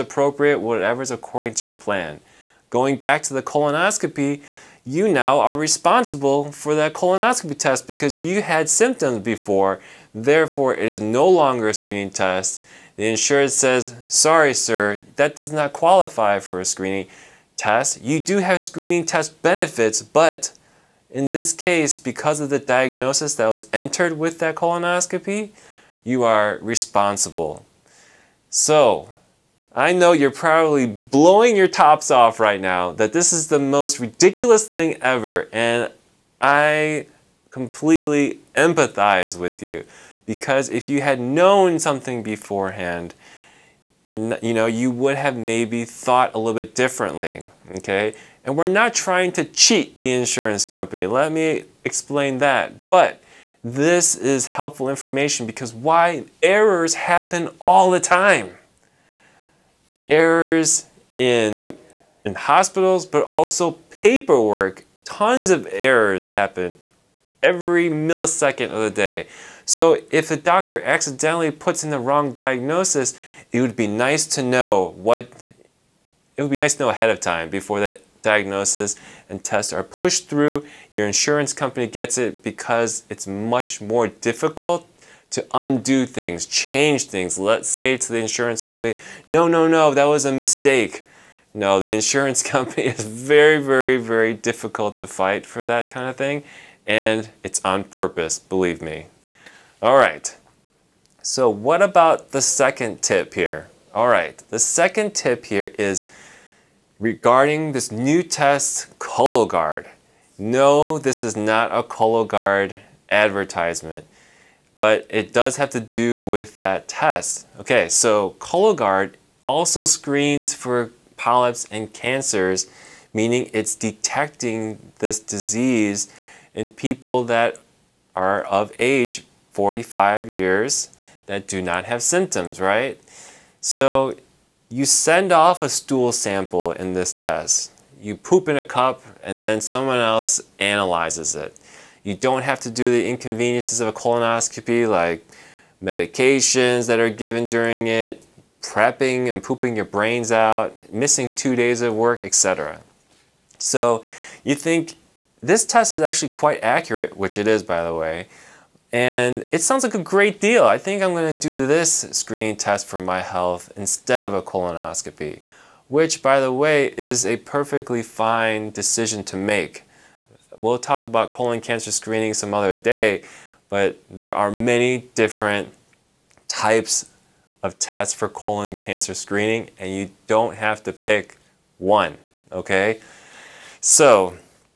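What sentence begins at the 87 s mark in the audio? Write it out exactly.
Let's say to the insurance company, no, no, no, that was a mistake.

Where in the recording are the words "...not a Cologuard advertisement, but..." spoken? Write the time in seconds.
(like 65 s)
111 s.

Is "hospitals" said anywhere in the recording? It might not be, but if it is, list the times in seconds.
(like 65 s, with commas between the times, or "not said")
62 s.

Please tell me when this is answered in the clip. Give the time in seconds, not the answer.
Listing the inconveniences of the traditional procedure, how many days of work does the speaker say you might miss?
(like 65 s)
151 s.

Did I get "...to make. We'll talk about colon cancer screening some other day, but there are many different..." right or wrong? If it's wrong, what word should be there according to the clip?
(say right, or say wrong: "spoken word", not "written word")
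right.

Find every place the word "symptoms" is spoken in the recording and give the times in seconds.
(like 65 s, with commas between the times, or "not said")
8 s, 132 s.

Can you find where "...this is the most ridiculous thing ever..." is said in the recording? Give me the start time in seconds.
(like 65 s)
33 s.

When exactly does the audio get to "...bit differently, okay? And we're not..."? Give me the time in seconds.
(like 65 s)
46 s.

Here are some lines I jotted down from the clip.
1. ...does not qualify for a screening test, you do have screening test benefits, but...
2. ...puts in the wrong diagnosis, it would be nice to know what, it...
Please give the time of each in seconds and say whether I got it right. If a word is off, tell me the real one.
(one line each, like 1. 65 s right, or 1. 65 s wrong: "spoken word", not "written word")
1. 15 s right
2. 71 s right.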